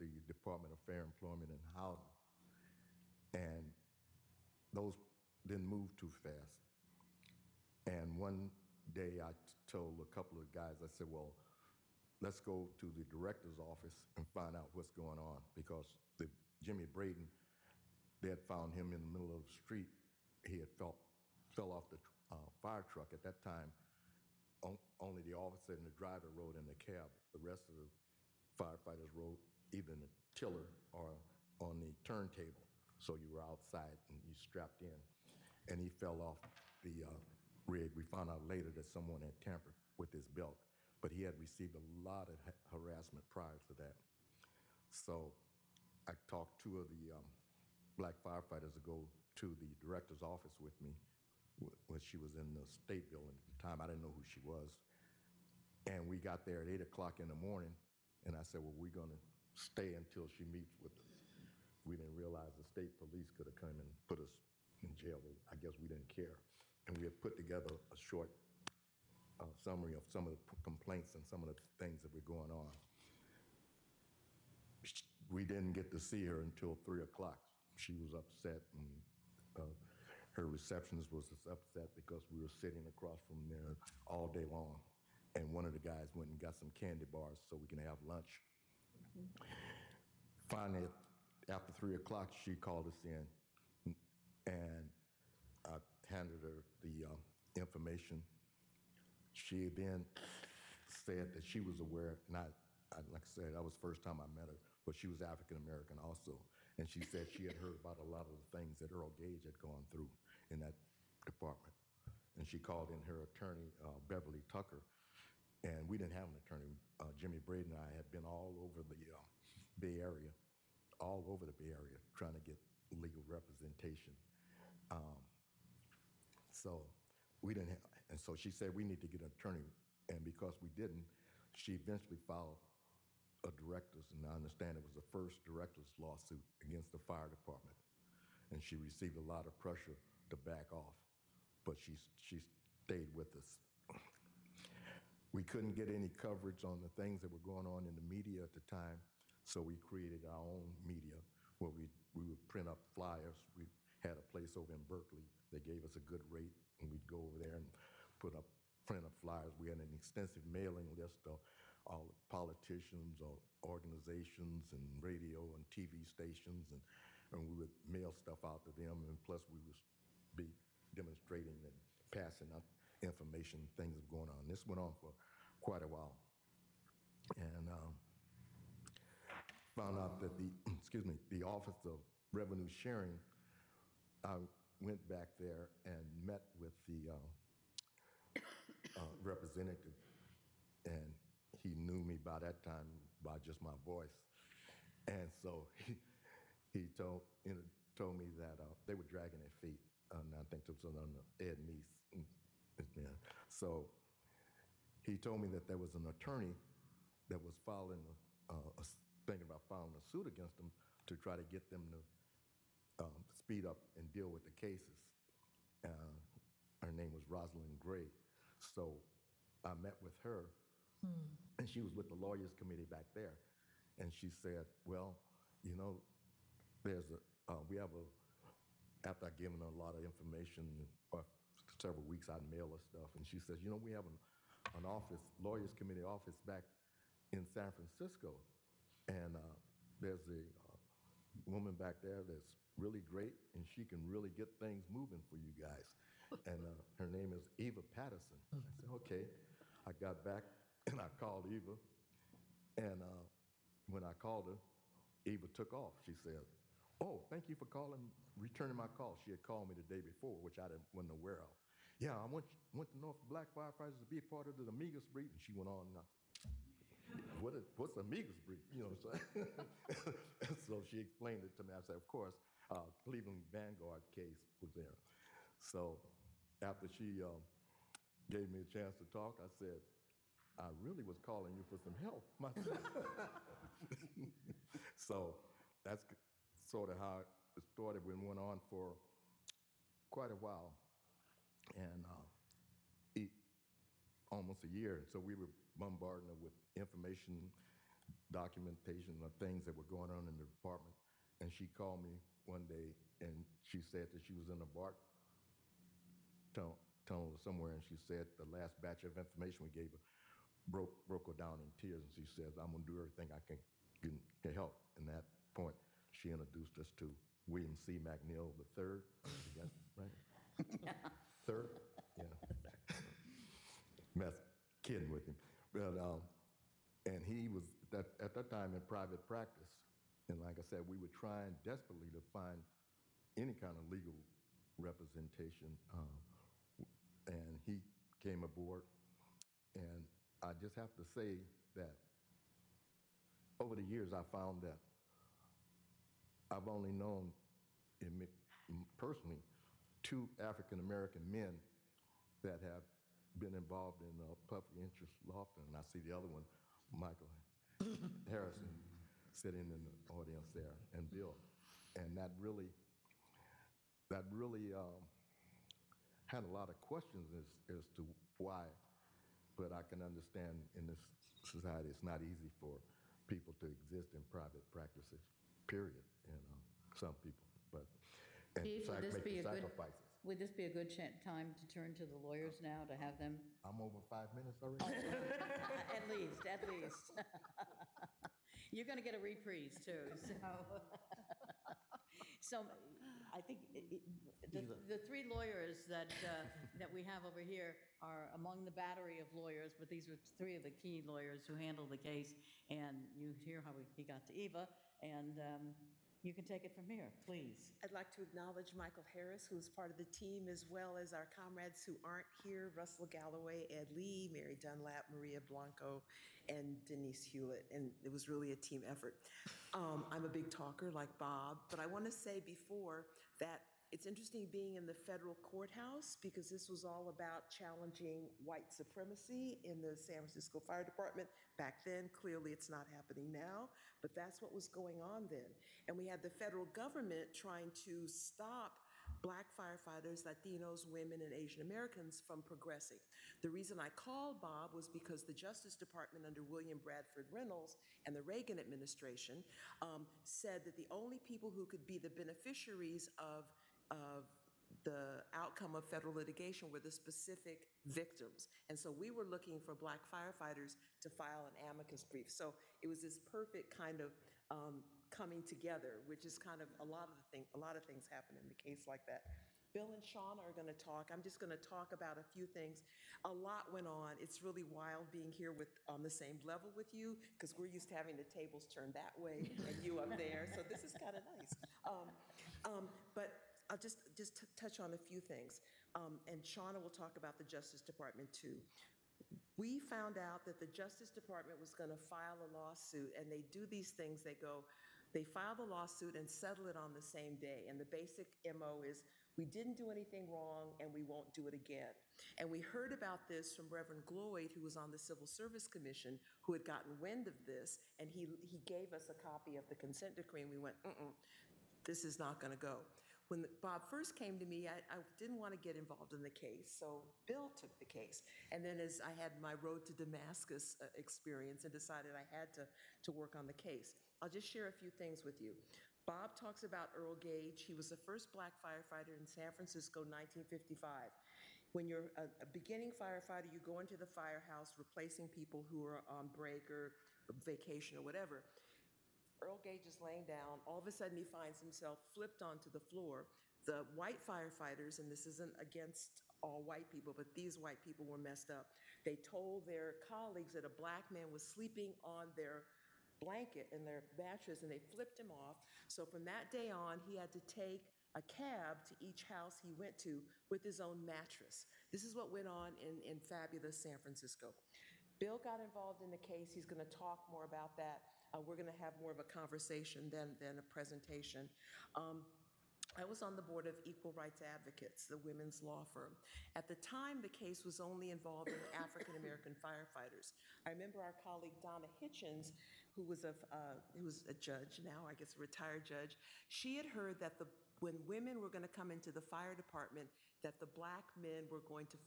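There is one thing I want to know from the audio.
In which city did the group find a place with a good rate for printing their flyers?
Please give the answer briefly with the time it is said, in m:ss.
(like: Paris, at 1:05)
Berkeley, at 2:34.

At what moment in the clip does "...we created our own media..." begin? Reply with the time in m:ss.
2:29.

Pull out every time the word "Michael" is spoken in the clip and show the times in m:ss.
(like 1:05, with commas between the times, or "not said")
5:56, 6:48.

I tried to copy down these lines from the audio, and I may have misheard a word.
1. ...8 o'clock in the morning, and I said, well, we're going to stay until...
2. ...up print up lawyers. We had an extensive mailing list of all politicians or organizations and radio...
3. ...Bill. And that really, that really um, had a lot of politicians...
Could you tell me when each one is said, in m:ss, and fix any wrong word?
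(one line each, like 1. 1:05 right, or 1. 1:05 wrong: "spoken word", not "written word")
1. 0:56 right
2. 2:38 wrong: "flyers", not "lawyers"
3. 6:01 wrong: "questions", not "politicians".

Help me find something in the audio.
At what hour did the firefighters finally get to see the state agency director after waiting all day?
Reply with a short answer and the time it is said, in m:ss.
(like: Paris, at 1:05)
3 o'clock, at 1:16.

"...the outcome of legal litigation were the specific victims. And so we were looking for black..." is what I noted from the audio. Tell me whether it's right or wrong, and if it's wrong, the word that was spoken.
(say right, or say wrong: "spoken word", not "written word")
wrong: "federal", not "legal".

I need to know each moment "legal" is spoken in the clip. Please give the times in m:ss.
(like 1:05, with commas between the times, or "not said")
2:02, 5:33.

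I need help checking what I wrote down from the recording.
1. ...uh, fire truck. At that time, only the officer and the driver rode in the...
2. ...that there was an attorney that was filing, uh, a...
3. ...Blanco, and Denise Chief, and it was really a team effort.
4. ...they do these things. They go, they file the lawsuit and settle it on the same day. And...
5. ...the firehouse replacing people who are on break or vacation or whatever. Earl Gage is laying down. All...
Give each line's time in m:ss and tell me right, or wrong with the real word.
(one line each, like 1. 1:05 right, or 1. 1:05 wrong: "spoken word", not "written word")
1. 0:22 right
2. 3:25 right
3. 6:55 wrong: "Hewlett", not "Chief"
4. 8:13 right
5. 8:53 right.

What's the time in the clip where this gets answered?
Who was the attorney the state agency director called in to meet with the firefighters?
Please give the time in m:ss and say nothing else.
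1:53.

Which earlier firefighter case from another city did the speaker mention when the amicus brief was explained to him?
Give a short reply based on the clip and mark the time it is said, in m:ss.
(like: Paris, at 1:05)
Cleveland Vanguard, at 4:32.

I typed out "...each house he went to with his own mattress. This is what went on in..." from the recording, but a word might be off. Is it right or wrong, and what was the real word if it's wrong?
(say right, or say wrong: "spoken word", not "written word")
right.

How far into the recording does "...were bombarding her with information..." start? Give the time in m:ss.
4:55.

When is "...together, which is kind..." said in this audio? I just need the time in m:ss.
7:45.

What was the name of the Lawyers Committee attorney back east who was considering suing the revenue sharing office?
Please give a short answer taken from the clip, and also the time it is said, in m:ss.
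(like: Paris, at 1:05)
Rosalind Gray, at 3:37.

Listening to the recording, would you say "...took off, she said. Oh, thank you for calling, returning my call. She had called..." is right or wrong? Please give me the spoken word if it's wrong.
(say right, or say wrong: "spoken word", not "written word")
right.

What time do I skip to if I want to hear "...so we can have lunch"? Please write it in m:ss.
1:27.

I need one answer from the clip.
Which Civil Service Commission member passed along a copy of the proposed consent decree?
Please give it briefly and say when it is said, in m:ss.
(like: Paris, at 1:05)
Reverend Gloyd, at 8:23.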